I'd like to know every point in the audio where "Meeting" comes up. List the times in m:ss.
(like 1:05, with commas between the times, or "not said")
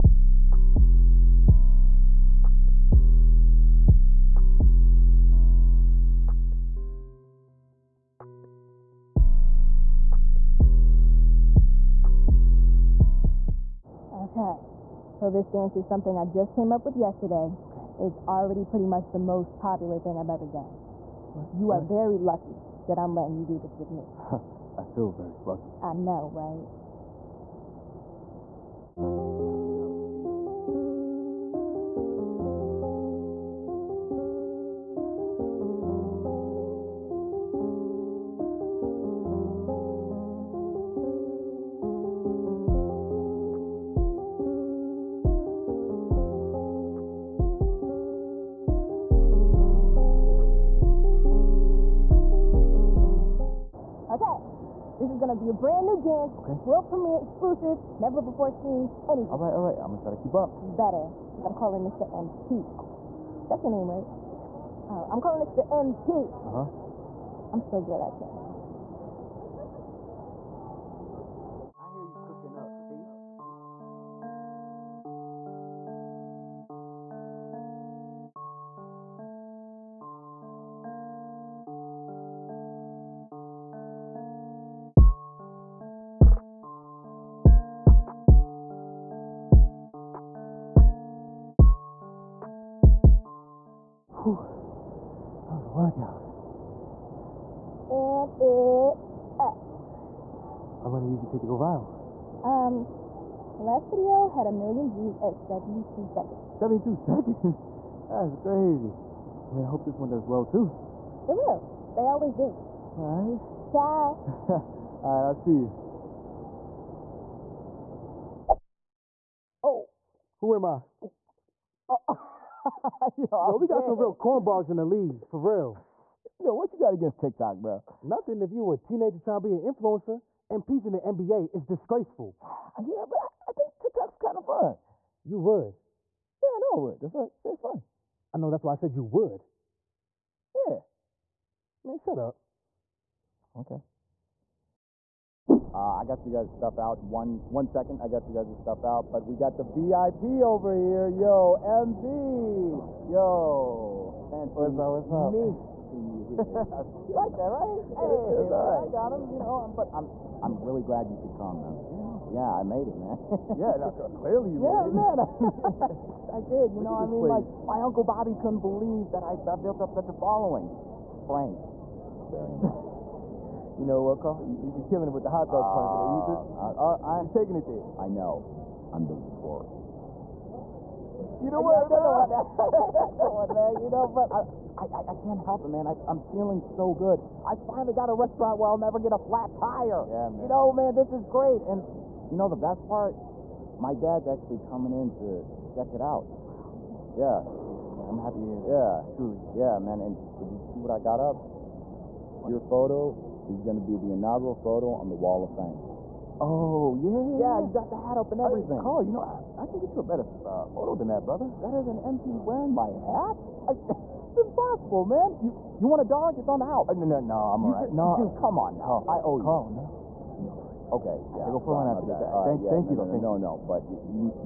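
2:35.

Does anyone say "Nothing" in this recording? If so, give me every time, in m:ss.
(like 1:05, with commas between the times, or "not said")
2:08.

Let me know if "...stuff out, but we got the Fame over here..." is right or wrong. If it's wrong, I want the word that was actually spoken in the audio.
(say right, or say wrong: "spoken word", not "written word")
wrong: "VIP", not "Fame".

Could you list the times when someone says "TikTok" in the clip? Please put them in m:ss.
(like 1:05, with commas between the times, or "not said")
2:07, 2:13.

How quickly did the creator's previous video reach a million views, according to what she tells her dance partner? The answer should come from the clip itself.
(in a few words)
72 seconds.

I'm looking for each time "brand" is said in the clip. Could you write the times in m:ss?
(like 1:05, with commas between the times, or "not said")
0:55.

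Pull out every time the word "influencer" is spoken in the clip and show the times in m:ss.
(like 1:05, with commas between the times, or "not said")
2:09.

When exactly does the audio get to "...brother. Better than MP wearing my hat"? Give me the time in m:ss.
3:31.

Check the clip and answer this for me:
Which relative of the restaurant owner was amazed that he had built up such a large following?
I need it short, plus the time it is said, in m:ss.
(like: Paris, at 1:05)
Uncle Bobby, at 2:47.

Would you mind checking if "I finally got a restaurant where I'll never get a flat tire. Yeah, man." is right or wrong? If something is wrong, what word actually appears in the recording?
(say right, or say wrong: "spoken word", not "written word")
right.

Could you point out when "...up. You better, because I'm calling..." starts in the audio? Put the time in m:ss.
1:00.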